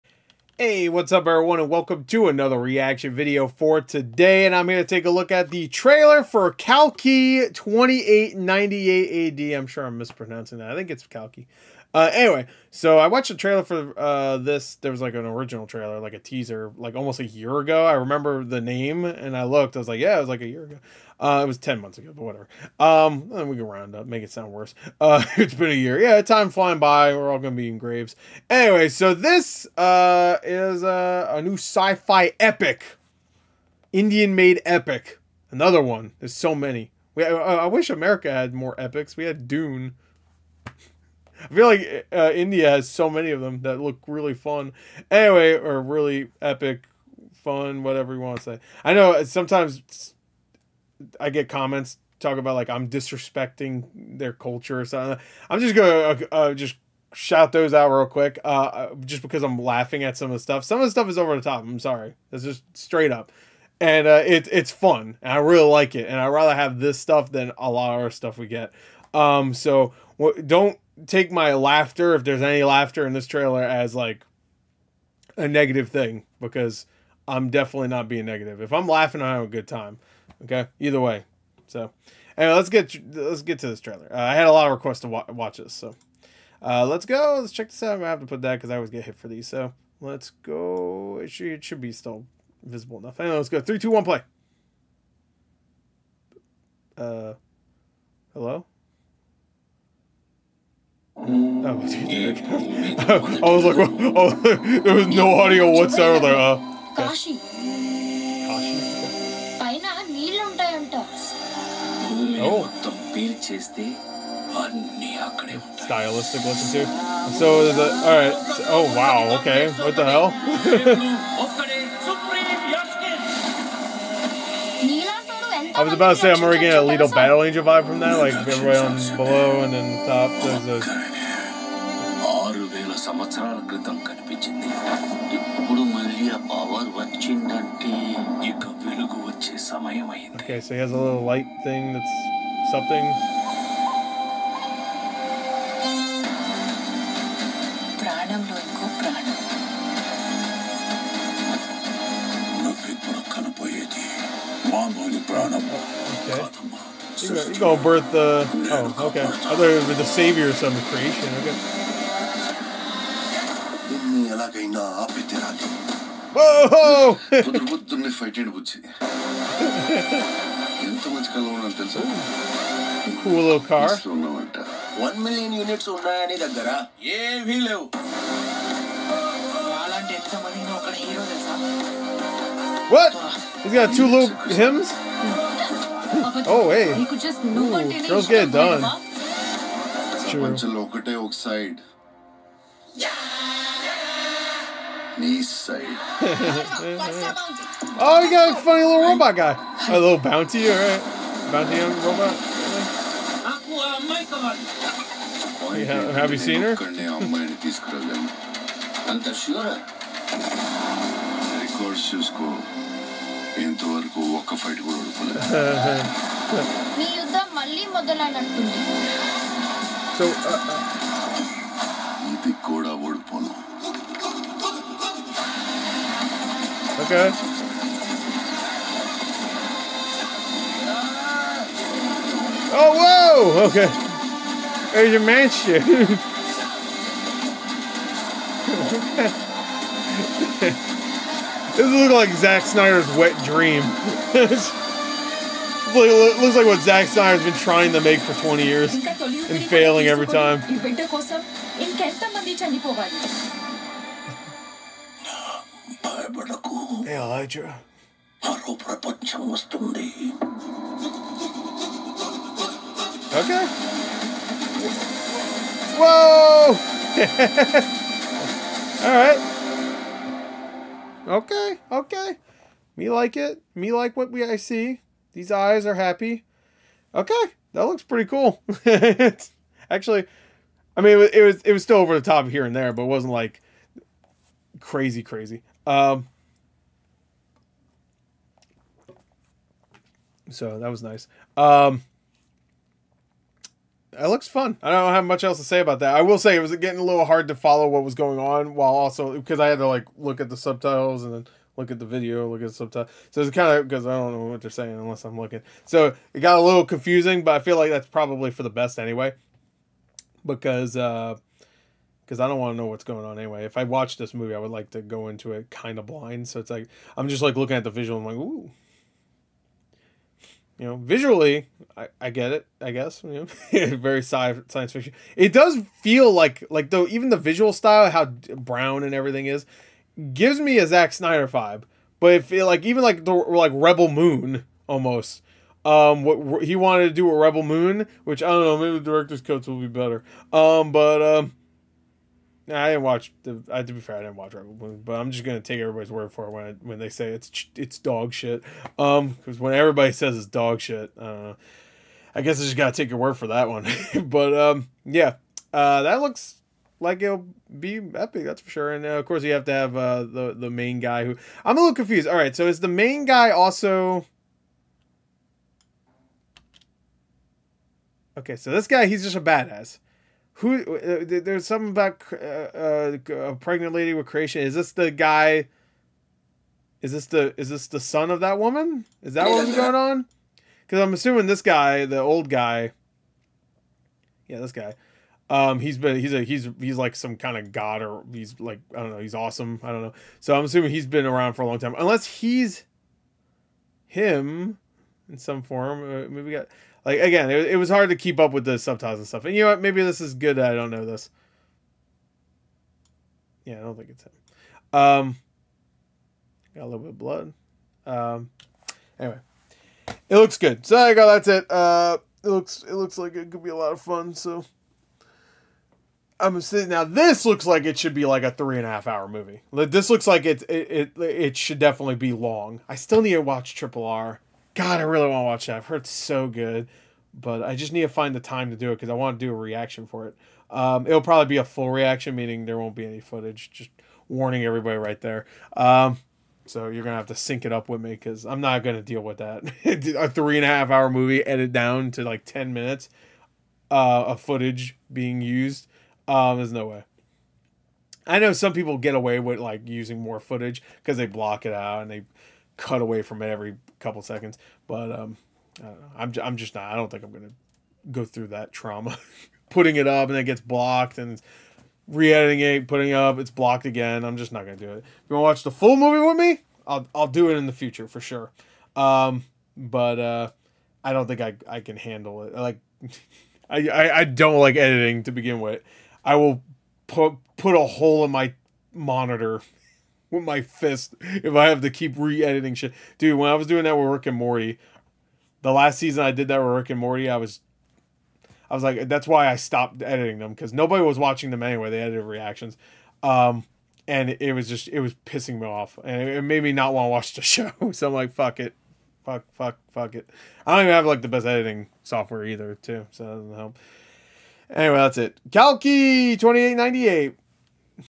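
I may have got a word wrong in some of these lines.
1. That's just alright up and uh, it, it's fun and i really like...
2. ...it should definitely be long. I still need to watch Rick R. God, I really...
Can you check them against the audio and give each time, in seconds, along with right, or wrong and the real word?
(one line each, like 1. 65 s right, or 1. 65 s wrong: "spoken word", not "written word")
1. 62 s wrong: "straight", not "alright"
2. 421 s wrong: "Triple", not "Rick".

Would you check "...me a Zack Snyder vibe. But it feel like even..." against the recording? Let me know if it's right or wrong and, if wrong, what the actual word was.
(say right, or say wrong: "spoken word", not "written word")
right.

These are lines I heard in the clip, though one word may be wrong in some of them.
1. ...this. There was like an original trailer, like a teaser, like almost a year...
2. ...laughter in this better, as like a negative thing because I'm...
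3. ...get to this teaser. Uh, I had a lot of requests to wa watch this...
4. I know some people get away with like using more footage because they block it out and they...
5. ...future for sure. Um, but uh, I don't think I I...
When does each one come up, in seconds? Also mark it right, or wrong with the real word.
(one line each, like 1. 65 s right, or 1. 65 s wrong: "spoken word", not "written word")
1. 14 s right
2. 72 s wrong: "trailer", not "better"
3. 83 s wrong: "trailer", not "teaser"
4. 448 s right
5. 467 s right.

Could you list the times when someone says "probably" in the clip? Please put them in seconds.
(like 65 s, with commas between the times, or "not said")
308 s, 431 s.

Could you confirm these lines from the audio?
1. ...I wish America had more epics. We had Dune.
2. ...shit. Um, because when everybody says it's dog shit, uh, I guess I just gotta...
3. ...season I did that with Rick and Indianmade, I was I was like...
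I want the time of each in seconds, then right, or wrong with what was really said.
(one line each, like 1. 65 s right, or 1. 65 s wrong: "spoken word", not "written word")
1. 37 s right
2. 348 s right
3. 485 s wrong: "Morty", not "Indianmade".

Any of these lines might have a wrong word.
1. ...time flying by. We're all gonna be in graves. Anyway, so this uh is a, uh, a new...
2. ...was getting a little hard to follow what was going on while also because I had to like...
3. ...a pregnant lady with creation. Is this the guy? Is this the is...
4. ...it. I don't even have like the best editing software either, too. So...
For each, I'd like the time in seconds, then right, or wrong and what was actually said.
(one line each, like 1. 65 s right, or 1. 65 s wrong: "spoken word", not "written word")
1. 26 s right
2. 296 s right
3. 373 s right
4. 500 s right.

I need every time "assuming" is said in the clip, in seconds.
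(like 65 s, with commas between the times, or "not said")
381 s, 390 s.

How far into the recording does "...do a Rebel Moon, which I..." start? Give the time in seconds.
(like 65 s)
337 s.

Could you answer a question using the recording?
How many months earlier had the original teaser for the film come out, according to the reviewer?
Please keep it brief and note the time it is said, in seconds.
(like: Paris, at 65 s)
10 months, at 21 s.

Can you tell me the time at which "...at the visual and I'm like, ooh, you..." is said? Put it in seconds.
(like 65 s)
317 s.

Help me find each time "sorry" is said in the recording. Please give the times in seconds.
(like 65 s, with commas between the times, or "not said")
61 s.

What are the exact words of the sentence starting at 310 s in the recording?
Because uh because I don't want to know what's going on anyway.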